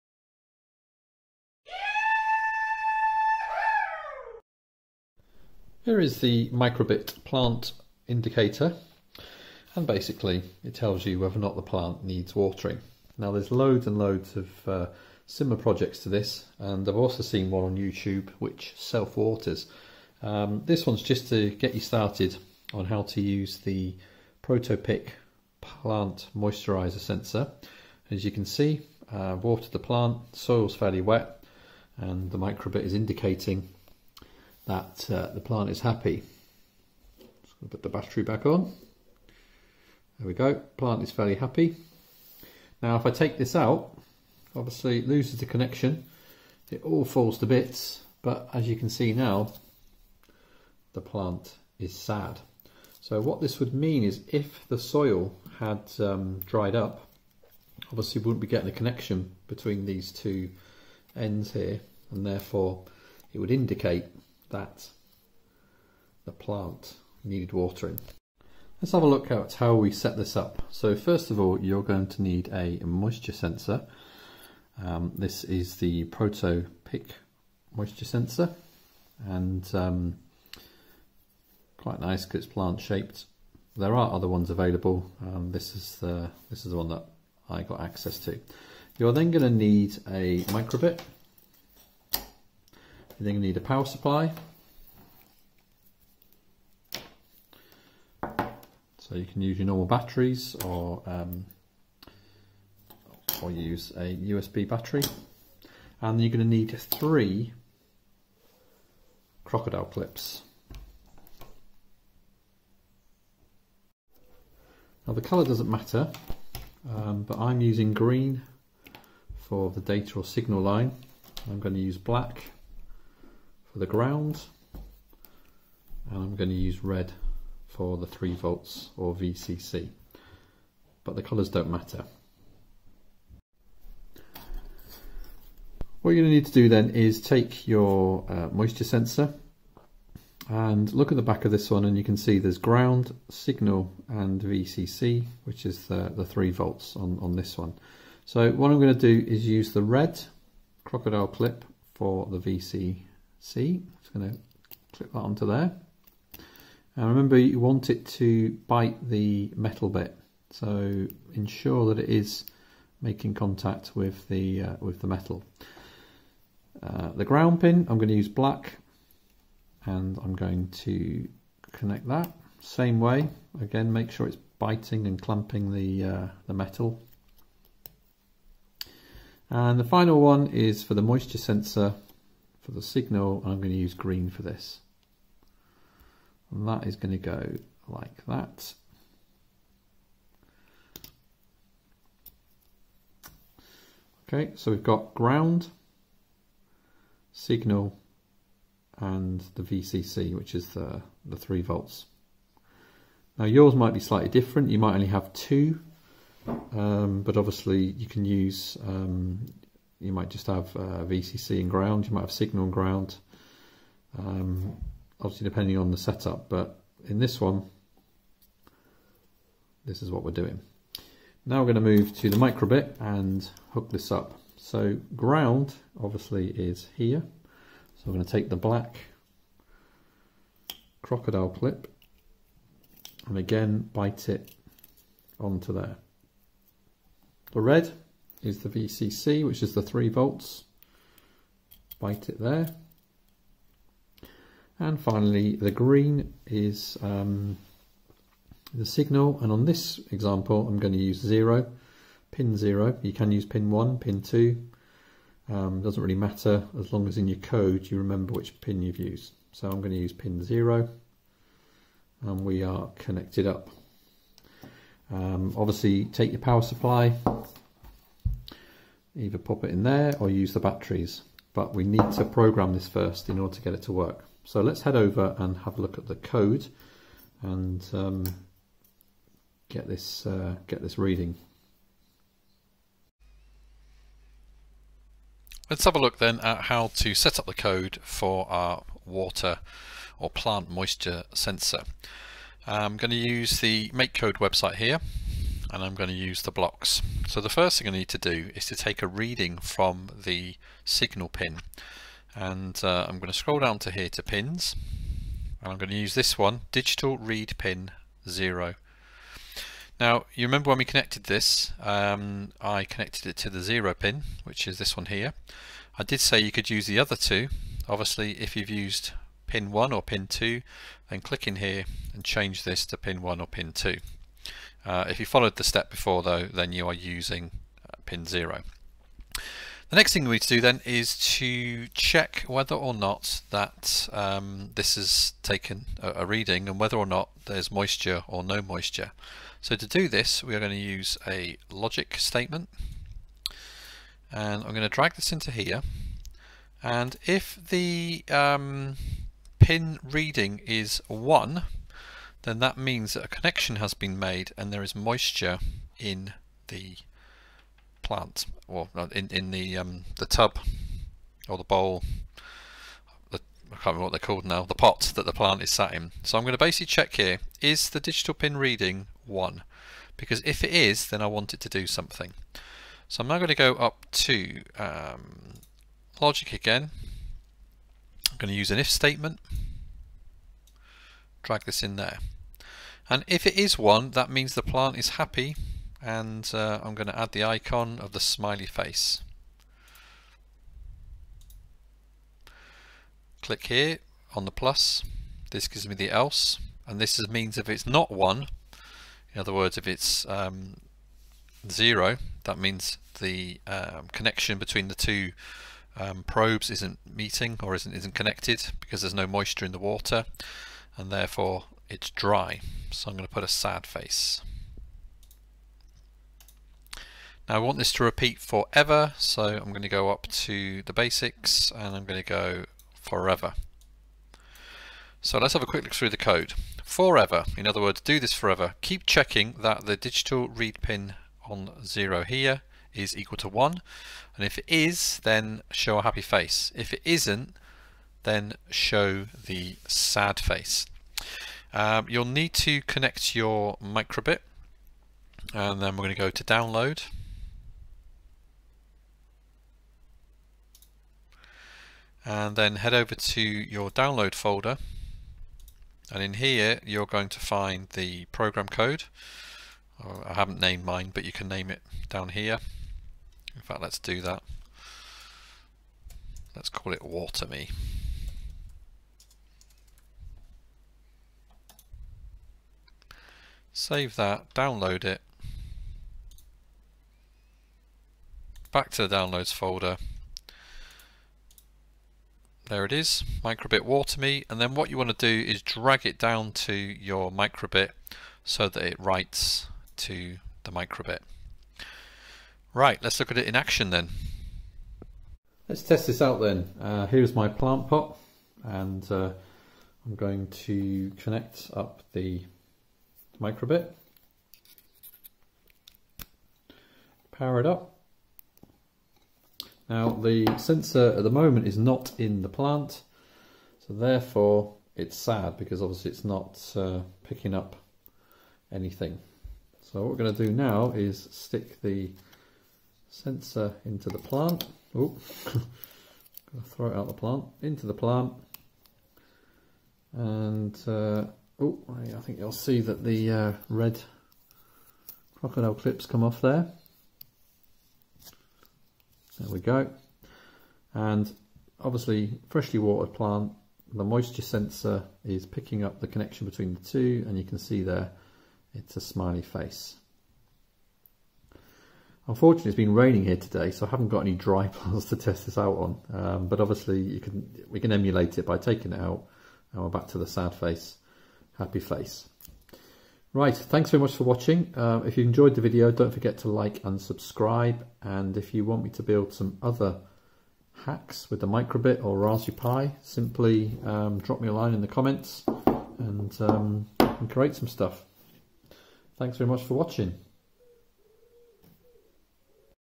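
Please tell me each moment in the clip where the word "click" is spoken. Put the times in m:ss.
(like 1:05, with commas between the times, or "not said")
5:21, 6:33.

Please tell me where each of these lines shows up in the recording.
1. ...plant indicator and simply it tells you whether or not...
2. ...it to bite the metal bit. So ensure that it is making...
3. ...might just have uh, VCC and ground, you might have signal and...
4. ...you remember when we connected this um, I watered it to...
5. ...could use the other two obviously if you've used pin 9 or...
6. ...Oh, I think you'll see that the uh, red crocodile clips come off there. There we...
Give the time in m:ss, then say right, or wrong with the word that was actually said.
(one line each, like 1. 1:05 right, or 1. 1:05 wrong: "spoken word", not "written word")
1. 0:07 wrong: "basically", not "simply"
2. 2:37 right
3. 3:30 right
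4. 5:10 wrong: "connected", not "watered"
5. 5:16 wrong: "1", not "9"
6. 8:51 right.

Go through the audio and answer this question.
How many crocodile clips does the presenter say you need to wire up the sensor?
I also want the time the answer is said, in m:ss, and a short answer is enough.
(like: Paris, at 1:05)
3, at 1:46.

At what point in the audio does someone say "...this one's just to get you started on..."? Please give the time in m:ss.
0:20.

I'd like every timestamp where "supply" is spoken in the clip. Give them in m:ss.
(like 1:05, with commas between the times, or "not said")
1:33, 4:26.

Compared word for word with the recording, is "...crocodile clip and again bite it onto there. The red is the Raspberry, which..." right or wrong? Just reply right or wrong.
wrong.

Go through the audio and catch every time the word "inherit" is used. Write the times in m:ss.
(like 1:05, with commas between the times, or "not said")
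not said.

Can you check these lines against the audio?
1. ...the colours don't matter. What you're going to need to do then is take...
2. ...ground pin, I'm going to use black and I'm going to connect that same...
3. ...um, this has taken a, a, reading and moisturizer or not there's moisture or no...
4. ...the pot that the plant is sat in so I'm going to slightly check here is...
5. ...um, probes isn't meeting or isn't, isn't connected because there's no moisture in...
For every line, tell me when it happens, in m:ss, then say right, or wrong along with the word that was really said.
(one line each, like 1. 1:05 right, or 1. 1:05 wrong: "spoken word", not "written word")
1. 2:11 right
2. 2:47 right
3. 5:34 wrong: "whether", not "moisturizer"
4. 6:04 wrong: "basically", not "slightly"
5. 6:45 right.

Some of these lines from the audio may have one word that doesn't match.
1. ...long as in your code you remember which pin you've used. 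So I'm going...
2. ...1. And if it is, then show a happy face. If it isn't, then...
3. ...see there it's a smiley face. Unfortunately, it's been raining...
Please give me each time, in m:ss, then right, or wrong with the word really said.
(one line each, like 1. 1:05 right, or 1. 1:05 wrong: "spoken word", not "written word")
1. 4:16 right
2. 7:13 right
3. 9:07 right.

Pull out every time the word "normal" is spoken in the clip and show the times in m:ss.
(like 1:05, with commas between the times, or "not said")
1:39.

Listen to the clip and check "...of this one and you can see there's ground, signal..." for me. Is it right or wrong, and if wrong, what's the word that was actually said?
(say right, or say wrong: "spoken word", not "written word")
right.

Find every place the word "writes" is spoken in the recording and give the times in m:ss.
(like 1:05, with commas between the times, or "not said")
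8:08.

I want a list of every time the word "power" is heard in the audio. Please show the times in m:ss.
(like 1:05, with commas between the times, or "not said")
1:33, 4:26, 8:27.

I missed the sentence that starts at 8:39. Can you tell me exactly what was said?
So what we're going to do now is stick the sensor into the plant.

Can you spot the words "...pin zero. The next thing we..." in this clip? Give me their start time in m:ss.
5:28.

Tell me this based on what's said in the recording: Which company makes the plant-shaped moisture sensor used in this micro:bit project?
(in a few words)
Proto-Pic.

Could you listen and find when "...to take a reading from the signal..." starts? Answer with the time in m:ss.
4:58.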